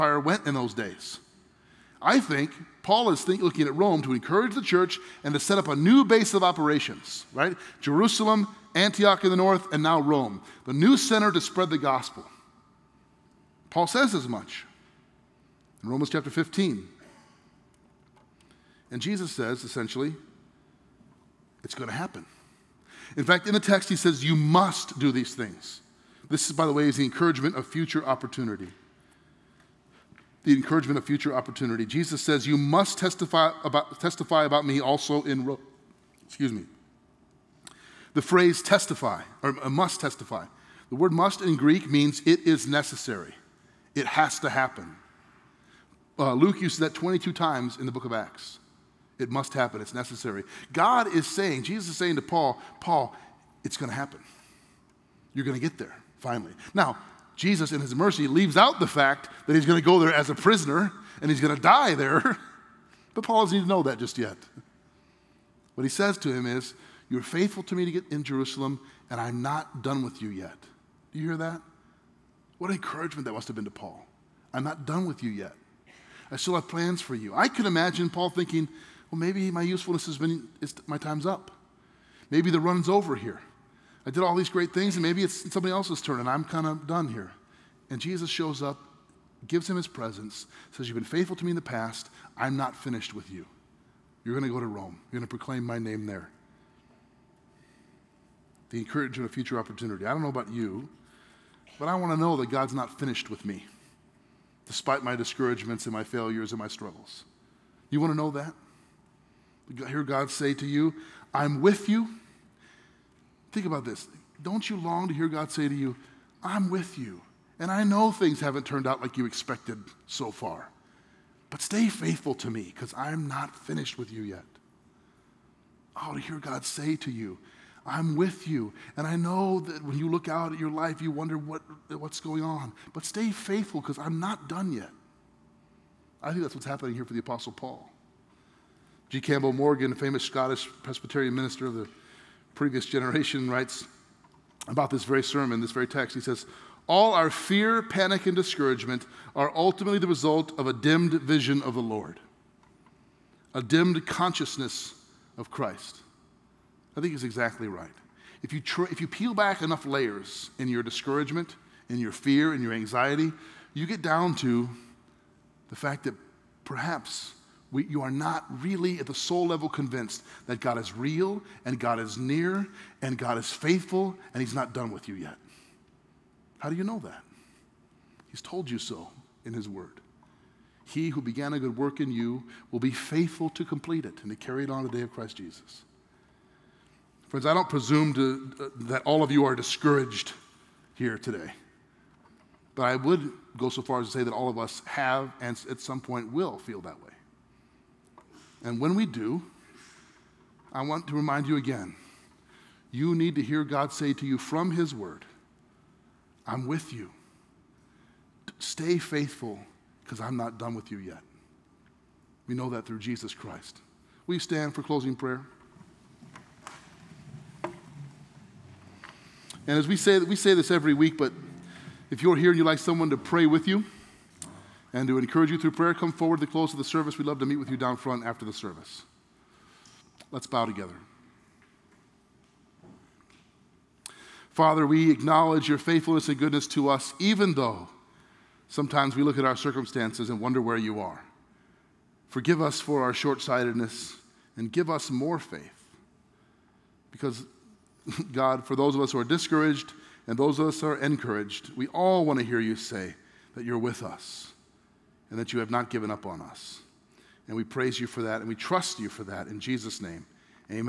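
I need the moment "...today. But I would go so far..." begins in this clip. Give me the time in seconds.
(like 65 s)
191 s.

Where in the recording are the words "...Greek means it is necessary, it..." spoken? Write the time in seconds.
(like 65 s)
41 s.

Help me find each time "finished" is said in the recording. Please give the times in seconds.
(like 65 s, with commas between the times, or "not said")
92 s, 102 s, 123 s.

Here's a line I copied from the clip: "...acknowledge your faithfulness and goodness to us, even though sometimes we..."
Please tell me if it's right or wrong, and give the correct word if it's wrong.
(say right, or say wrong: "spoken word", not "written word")
right.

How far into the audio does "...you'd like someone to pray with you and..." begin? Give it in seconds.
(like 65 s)
222 s.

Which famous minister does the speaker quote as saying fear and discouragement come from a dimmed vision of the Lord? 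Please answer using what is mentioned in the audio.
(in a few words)
G. Campbell Morgan.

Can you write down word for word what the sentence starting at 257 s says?
And we praise you for that and we trust you for that in Jesus' name.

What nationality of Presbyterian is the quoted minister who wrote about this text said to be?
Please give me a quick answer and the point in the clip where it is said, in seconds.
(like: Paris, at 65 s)
Scottish, at 140 s.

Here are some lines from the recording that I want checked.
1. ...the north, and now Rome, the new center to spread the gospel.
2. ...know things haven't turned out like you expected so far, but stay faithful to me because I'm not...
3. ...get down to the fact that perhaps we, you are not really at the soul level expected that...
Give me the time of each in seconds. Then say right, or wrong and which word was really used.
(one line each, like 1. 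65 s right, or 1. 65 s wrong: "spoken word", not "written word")
1. 9 s right
2. 117 s right
3. 163 s wrong: "convinced", not "expected".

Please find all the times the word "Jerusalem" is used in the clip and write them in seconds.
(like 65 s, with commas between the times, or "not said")
7 s, 68 s.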